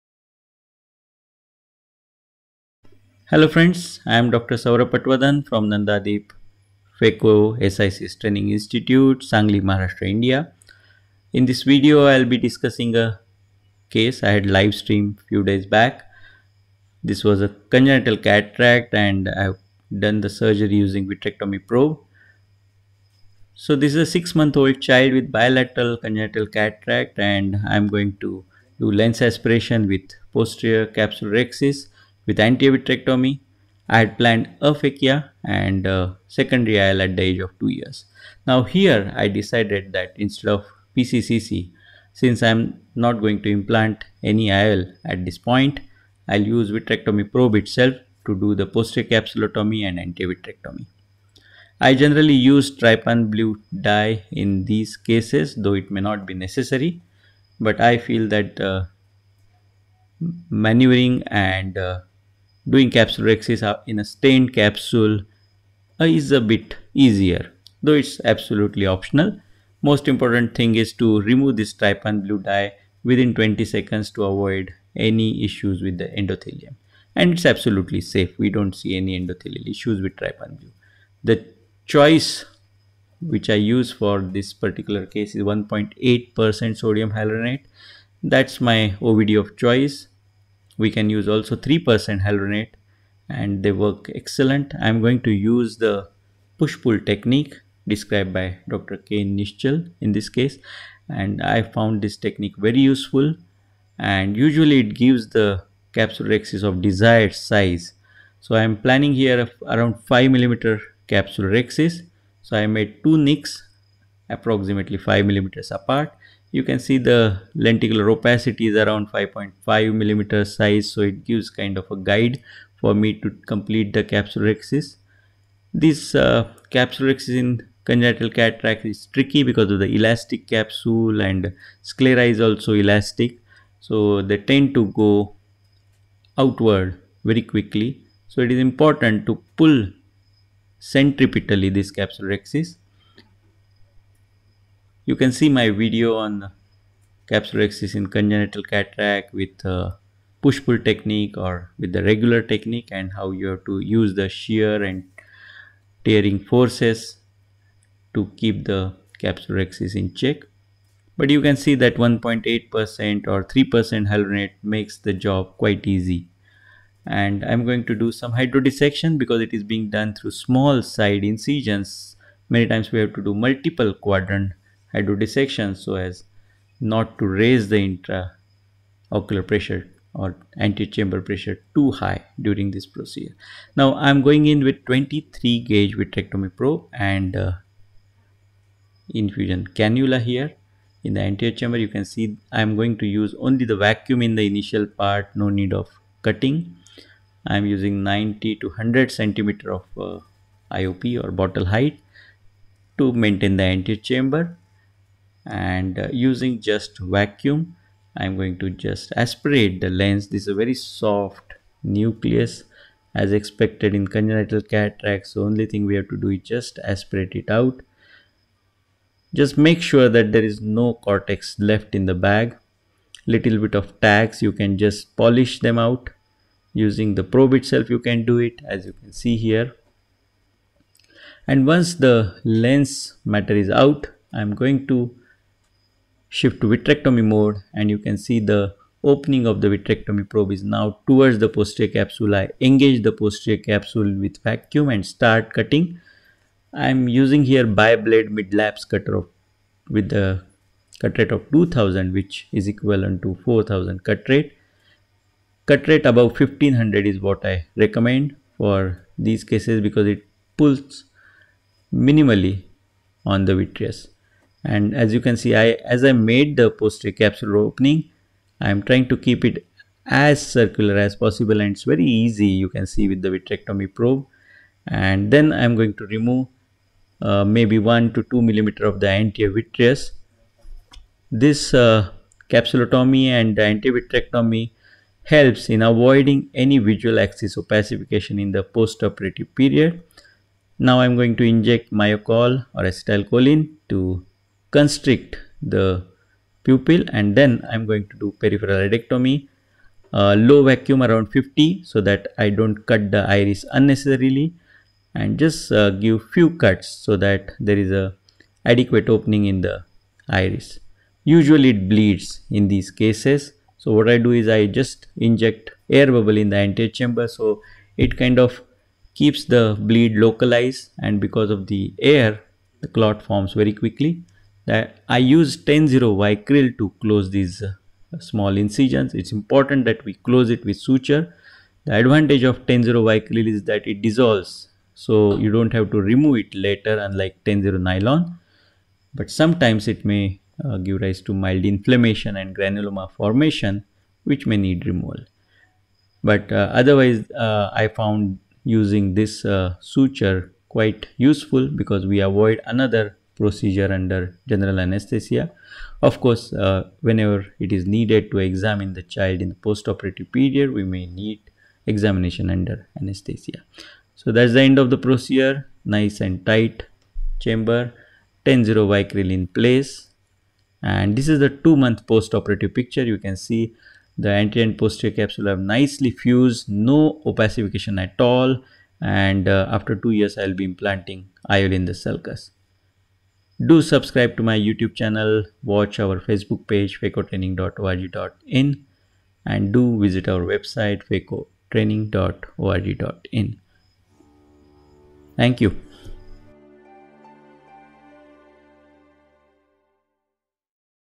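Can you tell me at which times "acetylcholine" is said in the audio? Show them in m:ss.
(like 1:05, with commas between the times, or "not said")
4:52.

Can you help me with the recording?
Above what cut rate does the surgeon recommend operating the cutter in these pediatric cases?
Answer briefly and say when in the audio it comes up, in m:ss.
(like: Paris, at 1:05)
1500, at 4:16.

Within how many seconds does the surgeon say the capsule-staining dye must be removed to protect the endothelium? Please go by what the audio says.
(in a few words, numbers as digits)
20 seconds.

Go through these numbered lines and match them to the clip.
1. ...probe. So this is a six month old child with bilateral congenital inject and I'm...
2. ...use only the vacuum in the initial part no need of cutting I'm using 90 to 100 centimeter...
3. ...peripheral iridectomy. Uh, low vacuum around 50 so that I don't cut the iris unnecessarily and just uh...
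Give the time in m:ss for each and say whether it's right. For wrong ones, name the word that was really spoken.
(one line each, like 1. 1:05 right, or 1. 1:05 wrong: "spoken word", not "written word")
1. 0:21 wrong: "cataract", not "inject"
2. 3:13 right
3. 4:58 right.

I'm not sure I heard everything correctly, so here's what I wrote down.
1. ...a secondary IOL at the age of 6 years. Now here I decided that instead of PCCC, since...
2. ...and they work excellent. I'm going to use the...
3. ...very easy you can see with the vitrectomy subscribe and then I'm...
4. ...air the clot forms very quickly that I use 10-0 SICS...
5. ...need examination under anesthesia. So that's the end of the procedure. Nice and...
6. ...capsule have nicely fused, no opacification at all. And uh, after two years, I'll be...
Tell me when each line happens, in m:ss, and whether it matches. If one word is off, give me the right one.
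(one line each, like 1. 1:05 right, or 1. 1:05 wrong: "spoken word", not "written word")
1. 0:35 wrong: "2", not "6"
2. 1:33 right
3. 4:31 wrong: "probe", not "subscribe"
4. 5:21 wrong: "Vicryl", not "SICS"
5. 6:01 right
6. 6:15 right.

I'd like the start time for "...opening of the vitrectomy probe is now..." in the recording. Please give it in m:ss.
3:59.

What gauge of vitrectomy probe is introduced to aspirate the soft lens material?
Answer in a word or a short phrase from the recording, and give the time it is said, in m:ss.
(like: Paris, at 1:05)
23 gauge, at 3:04.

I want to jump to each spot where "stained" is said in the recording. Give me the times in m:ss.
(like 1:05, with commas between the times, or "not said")
1:04.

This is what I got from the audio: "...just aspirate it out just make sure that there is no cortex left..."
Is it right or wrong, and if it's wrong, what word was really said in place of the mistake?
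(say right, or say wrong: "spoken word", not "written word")
right.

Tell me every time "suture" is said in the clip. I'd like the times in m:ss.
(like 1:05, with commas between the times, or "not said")
5:30, 5:49.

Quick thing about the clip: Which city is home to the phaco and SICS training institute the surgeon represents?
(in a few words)
Sangli.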